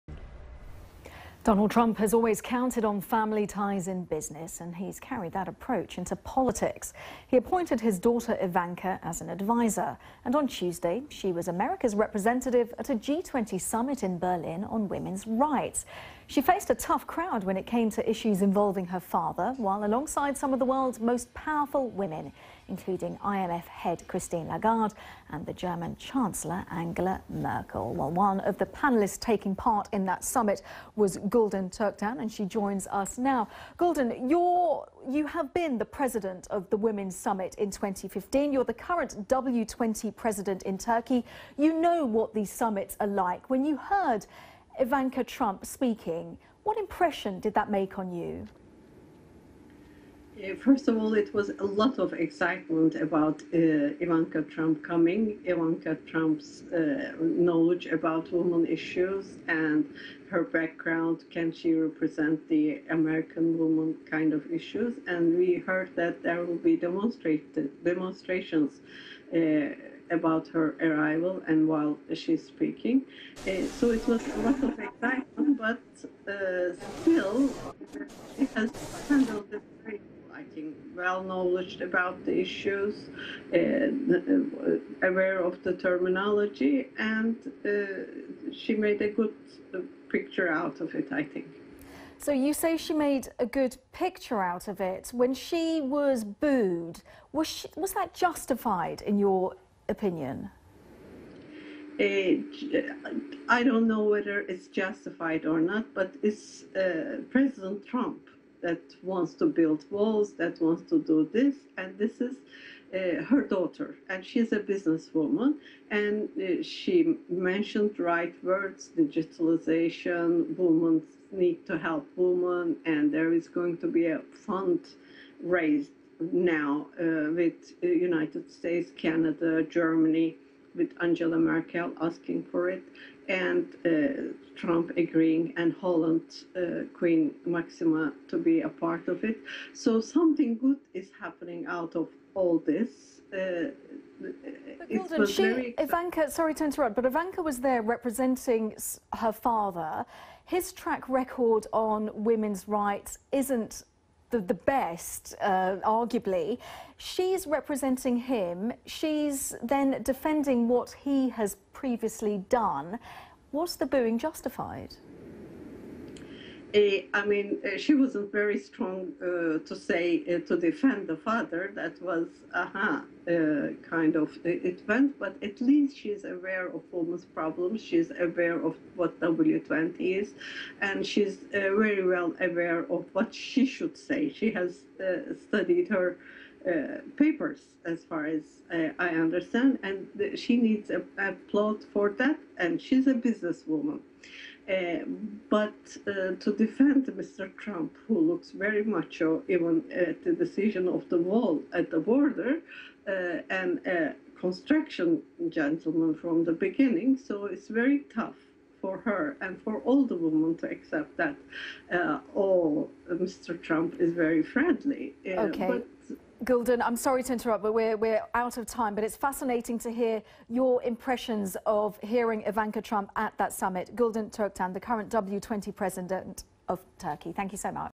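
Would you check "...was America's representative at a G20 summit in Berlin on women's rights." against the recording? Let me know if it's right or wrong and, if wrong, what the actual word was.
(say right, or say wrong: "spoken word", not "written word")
right.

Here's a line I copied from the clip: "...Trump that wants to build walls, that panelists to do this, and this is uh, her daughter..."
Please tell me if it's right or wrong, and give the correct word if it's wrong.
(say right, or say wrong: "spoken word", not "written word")
wrong: "wants", not "panelists".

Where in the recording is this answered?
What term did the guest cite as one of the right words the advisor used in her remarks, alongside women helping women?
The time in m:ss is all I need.
1:58.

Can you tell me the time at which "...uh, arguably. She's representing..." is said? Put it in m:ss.
2:35.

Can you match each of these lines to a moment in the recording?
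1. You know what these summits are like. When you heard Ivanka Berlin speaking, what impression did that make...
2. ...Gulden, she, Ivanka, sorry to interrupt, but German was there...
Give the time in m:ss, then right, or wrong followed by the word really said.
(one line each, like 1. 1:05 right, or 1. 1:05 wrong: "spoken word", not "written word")
1. 0:41 wrong: "Trump", not "Berlin"
2. 2:24 wrong: "Ivanka", not "German".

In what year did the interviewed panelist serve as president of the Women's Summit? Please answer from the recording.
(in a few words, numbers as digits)
2015.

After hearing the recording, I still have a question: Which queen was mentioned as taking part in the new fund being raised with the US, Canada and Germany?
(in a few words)
Queen Maxima.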